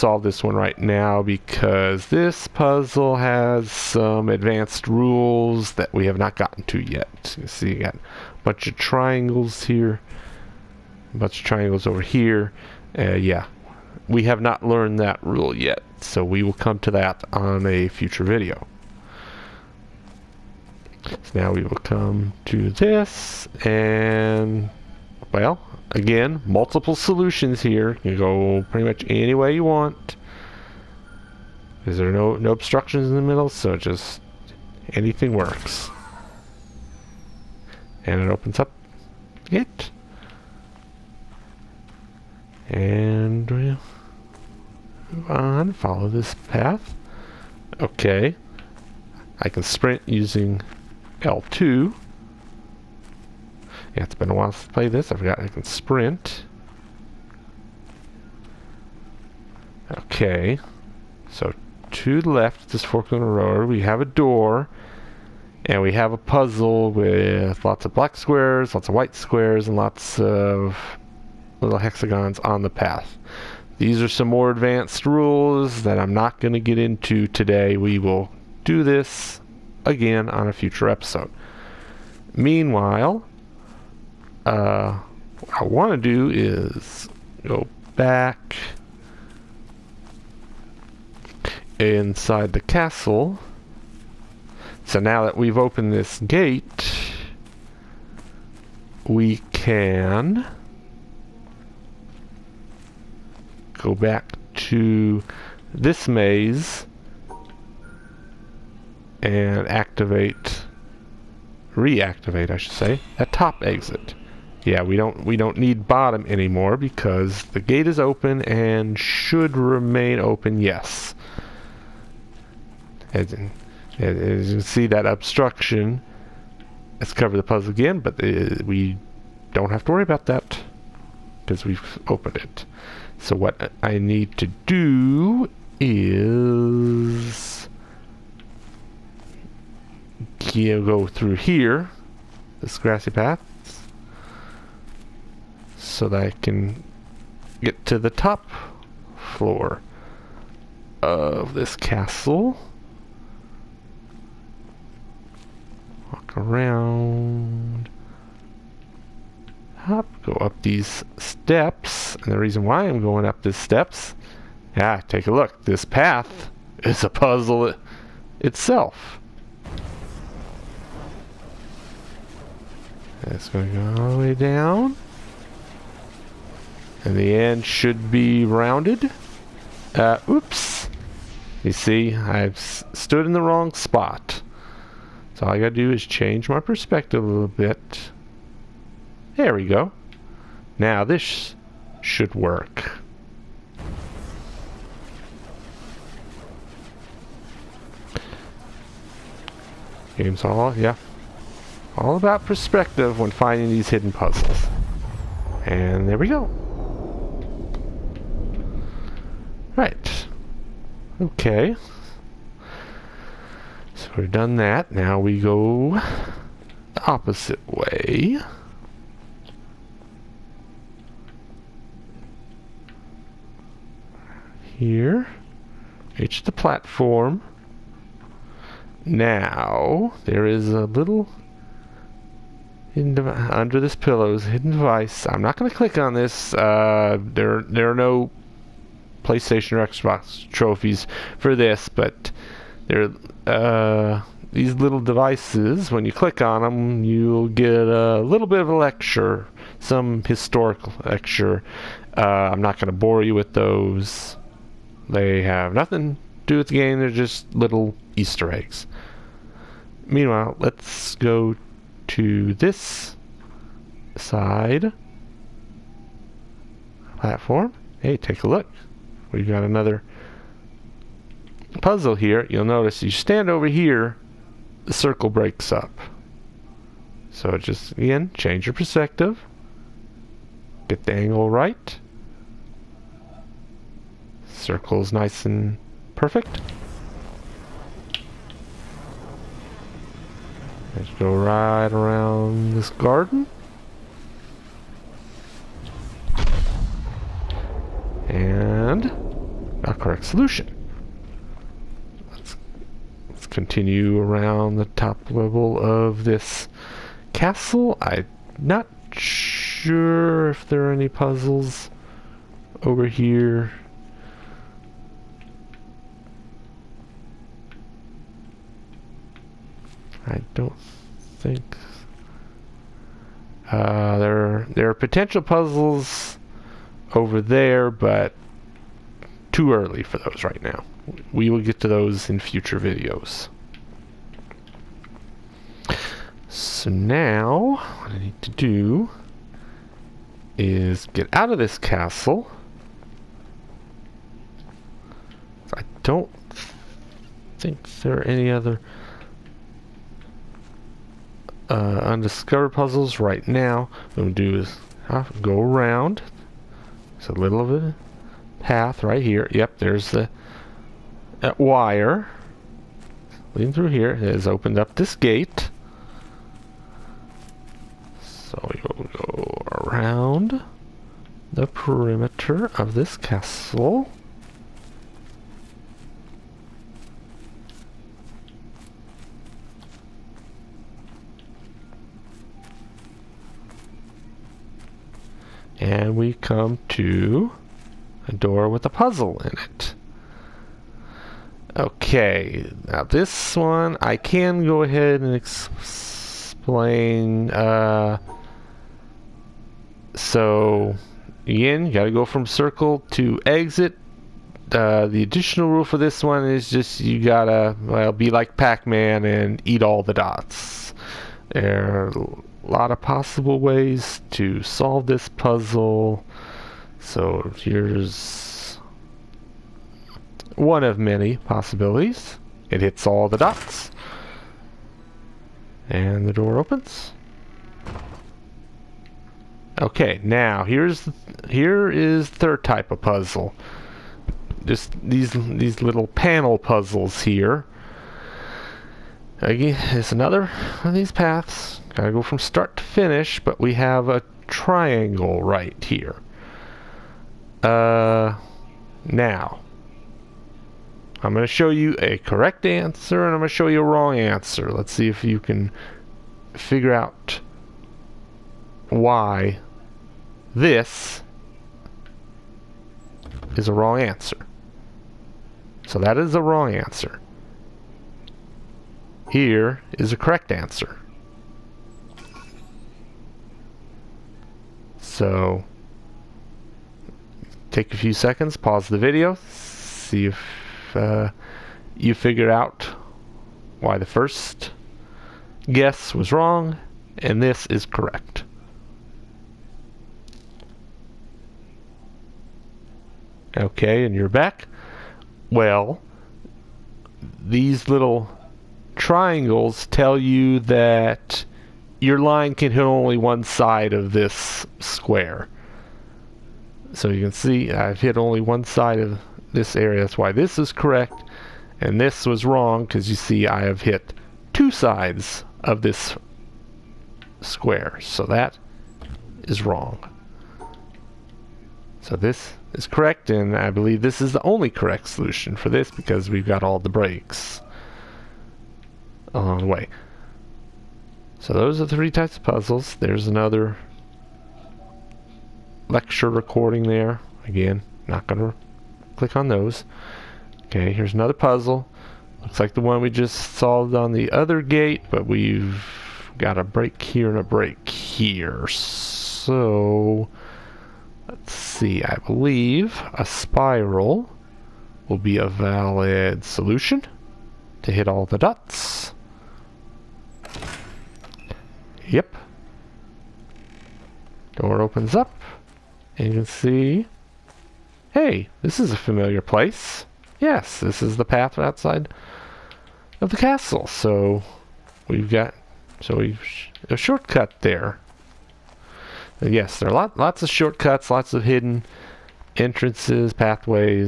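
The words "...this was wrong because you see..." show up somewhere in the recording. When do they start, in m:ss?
8:31.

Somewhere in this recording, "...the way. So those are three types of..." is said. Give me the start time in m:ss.
8:49.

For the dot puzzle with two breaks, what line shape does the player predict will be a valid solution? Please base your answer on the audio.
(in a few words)
spiral.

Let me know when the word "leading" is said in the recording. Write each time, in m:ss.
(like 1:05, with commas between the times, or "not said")
6:03.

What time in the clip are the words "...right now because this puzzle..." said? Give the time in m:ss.
0:00.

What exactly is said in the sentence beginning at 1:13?
These are some more advanced rules that I'm not going to get into today.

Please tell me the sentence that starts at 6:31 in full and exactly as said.
Okay, now this one I can go ahead and ex explain.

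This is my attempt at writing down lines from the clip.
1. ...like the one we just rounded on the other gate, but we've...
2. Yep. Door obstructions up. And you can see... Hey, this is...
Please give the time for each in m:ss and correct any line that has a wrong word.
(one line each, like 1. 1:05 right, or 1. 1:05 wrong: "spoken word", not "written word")
1. 9:02 wrong: "solved", not "rounded"
2. 9:22 wrong: "opens", not "obstructions".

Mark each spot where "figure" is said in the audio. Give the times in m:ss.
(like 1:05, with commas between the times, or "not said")
7:36, 8:02.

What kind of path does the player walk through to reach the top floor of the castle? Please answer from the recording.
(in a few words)
grassy path.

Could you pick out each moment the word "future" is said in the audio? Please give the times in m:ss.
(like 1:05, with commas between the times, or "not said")
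0:17, 1:20, 5:32.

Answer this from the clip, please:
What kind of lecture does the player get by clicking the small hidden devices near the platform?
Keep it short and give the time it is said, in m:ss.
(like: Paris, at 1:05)
historical lecture, at 4:10.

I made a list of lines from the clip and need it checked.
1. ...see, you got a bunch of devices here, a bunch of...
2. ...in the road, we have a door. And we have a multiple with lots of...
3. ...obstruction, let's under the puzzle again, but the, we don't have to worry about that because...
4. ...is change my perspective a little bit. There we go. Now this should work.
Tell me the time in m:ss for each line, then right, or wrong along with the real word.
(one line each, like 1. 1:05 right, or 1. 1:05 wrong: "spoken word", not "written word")
1. 0:07 wrong: "triangles", not "devices"
2. 1:03 wrong: "puzzle", not "multiple"
3. 2:05 wrong: "cover", not "under"
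4. 3:05 right.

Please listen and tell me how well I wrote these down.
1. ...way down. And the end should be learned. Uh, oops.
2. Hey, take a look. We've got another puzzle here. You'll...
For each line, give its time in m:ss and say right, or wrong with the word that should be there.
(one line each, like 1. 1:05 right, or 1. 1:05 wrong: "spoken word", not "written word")
1. 2:54 wrong: "rounded", not "learned"
2. 4:27 right.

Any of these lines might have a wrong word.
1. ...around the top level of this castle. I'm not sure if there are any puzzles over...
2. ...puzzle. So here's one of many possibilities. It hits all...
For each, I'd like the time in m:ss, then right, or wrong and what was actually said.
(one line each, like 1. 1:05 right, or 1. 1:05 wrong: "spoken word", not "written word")
1. 5:04 right
2. 6:55 right.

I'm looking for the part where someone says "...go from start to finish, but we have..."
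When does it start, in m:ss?
7:22.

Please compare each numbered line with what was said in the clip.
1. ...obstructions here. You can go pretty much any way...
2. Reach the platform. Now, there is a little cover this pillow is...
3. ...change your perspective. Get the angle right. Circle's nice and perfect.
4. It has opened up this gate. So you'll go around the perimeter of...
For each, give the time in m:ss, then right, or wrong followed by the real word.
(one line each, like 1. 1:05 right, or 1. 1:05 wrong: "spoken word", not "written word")
1. 0:26 wrong: "solutions", not "obstructions"
2. 3:46 wrong: "under", not "cover"
3. 4:38 right
4. 6:04 right.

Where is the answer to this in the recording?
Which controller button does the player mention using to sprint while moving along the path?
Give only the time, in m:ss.
0:51.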